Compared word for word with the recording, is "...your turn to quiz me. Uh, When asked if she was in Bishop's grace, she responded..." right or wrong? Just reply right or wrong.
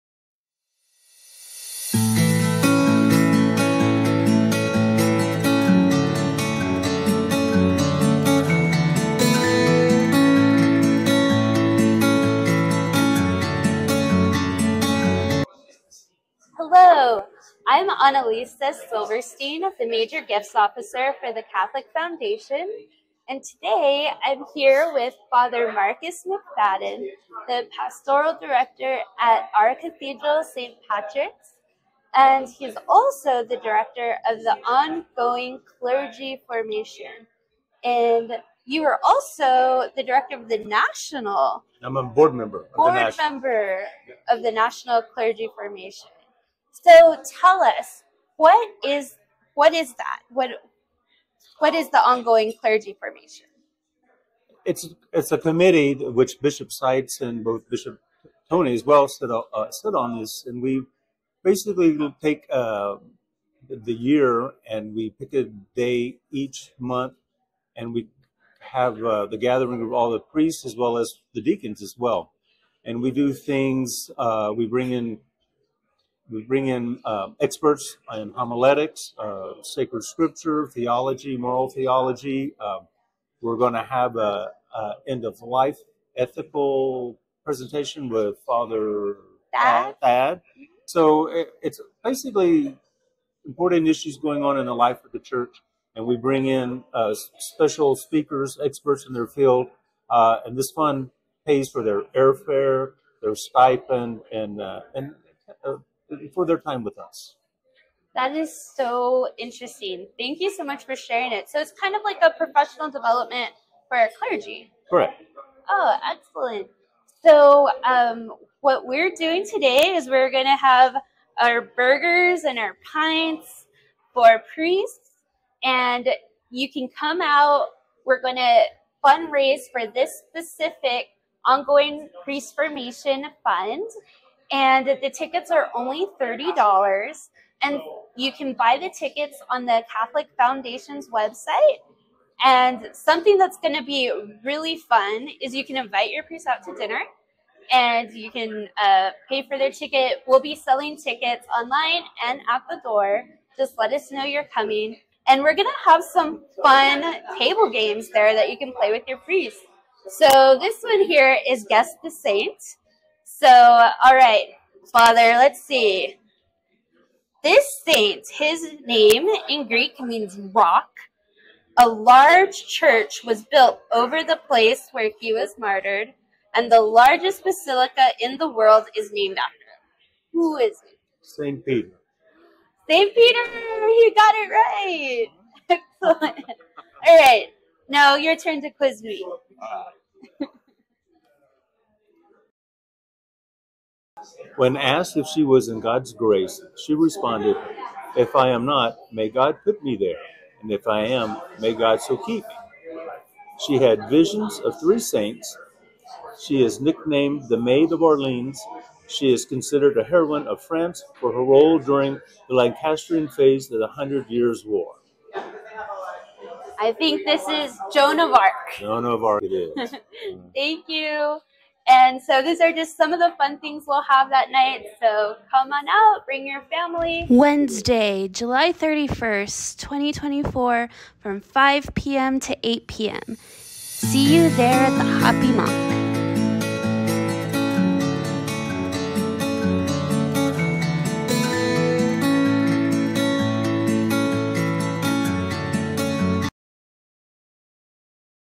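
wrong.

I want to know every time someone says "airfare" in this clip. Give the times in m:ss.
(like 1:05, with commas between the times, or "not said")
1:42.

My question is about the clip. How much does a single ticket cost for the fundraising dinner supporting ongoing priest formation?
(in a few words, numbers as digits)
$30.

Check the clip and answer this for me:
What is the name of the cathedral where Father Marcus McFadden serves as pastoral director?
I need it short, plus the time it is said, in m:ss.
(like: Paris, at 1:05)
St. Patrick's, at 0:30.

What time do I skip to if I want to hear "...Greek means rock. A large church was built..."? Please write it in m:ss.
2:49.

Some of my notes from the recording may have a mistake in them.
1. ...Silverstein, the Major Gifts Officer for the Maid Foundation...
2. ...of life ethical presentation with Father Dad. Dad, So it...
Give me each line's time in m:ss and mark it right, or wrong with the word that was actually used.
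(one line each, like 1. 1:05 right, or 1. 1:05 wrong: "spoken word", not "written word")
1. 0:18 wrong: "Catholic", not "Maid"
2. 1:25 right.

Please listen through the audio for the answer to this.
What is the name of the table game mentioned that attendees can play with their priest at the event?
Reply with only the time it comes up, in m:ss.
2:41.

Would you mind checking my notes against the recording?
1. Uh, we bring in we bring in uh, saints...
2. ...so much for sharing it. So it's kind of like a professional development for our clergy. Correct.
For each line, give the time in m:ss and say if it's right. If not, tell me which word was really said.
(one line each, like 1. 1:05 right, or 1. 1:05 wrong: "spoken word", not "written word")
1. 1:14 wrong: "experts", not "saints"
2. 1:50 right.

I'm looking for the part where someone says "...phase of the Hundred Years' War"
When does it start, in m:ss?
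3:33.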